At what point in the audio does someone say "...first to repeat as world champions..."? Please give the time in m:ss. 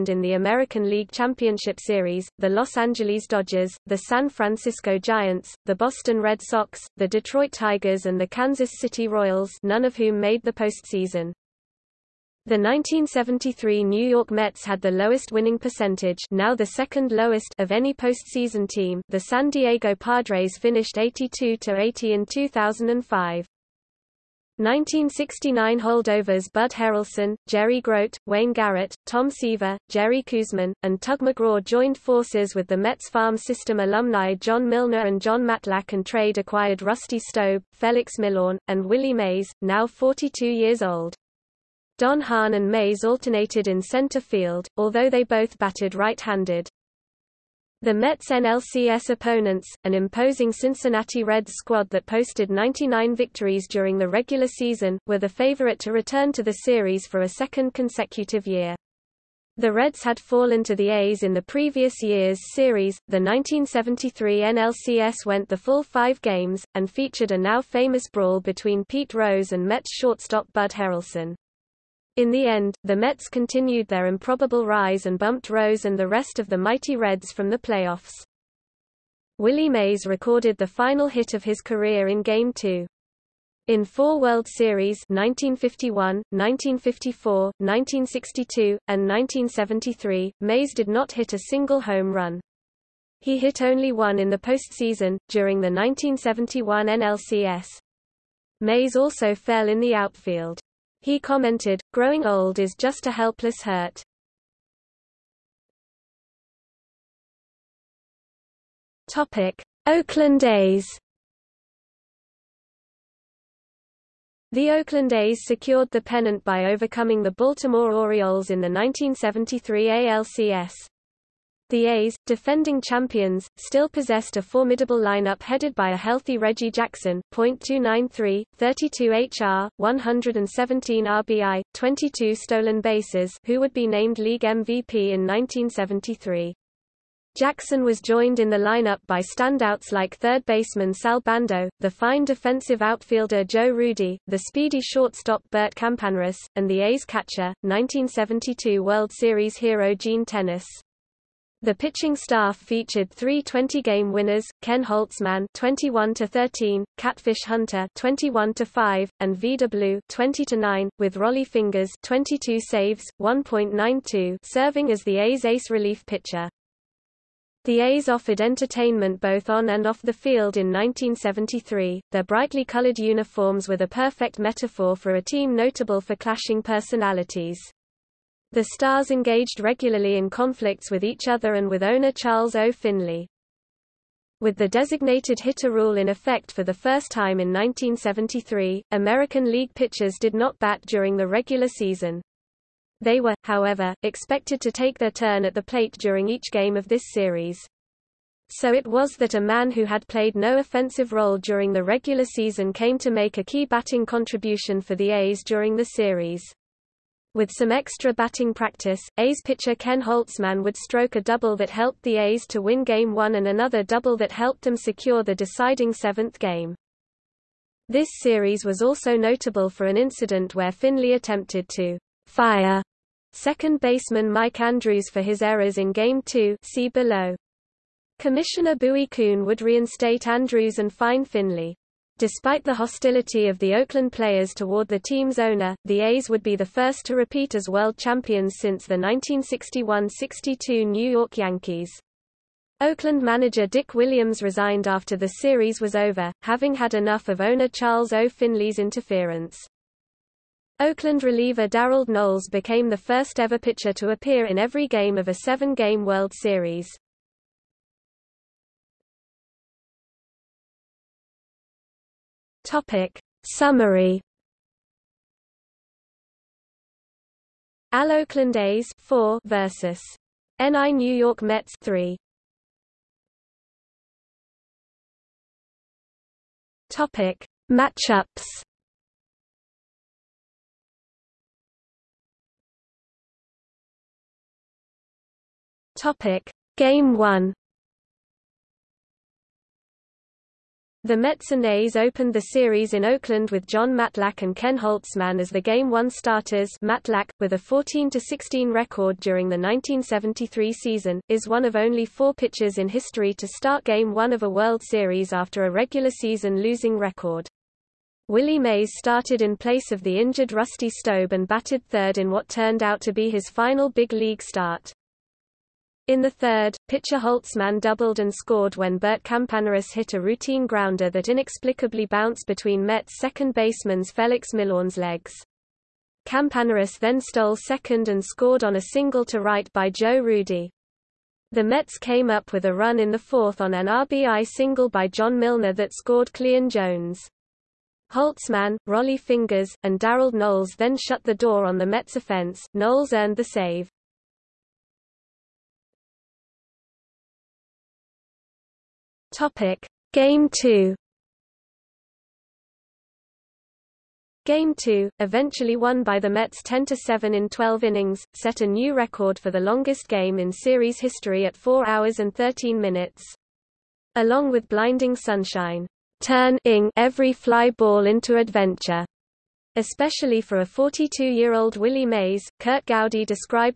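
3:56.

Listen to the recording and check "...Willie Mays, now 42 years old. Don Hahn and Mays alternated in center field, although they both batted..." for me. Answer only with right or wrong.
right.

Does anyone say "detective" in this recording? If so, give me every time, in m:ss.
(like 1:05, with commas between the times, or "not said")
not said.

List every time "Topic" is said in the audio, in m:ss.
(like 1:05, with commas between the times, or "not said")
1:49, 4:22, 4:36, 4:45, 5:49.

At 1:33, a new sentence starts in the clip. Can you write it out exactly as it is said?
He hit only one in the postseason, during the 1971 NLCS.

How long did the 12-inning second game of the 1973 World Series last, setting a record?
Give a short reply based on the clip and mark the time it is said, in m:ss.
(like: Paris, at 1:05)
4 hours and 13 minutes, at 6:01.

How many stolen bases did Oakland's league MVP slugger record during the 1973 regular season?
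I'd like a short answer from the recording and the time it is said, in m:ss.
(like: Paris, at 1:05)
22, at 2:11.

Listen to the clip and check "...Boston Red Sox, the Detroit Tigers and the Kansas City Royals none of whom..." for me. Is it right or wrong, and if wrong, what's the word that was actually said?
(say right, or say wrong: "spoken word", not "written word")
right.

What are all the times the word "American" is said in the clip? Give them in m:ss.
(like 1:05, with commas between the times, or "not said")
0:00, 3:08.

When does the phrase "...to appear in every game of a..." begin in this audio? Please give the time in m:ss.
4:13.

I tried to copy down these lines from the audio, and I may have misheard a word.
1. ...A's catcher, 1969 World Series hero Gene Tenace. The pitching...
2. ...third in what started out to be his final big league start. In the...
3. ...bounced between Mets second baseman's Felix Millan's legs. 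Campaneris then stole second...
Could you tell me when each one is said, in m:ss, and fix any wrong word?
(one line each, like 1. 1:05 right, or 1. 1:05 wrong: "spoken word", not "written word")
1. 2:26 wrong: "1972", not "1969"
2. 5:11 wrong: "turned", not "started"
3. 5:22 right.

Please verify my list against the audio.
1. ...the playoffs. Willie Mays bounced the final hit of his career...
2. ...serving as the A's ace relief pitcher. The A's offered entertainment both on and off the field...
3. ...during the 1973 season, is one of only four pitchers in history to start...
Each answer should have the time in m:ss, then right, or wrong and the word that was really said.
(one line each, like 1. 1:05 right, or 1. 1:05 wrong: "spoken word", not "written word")
1. 1:17 wrong: "recorded", not "bounced"
2. 2:44 right
3. 4:59 right.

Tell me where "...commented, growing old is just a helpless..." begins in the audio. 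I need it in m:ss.
1:41.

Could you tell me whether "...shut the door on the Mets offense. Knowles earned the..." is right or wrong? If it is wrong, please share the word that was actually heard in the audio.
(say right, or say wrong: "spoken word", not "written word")
right.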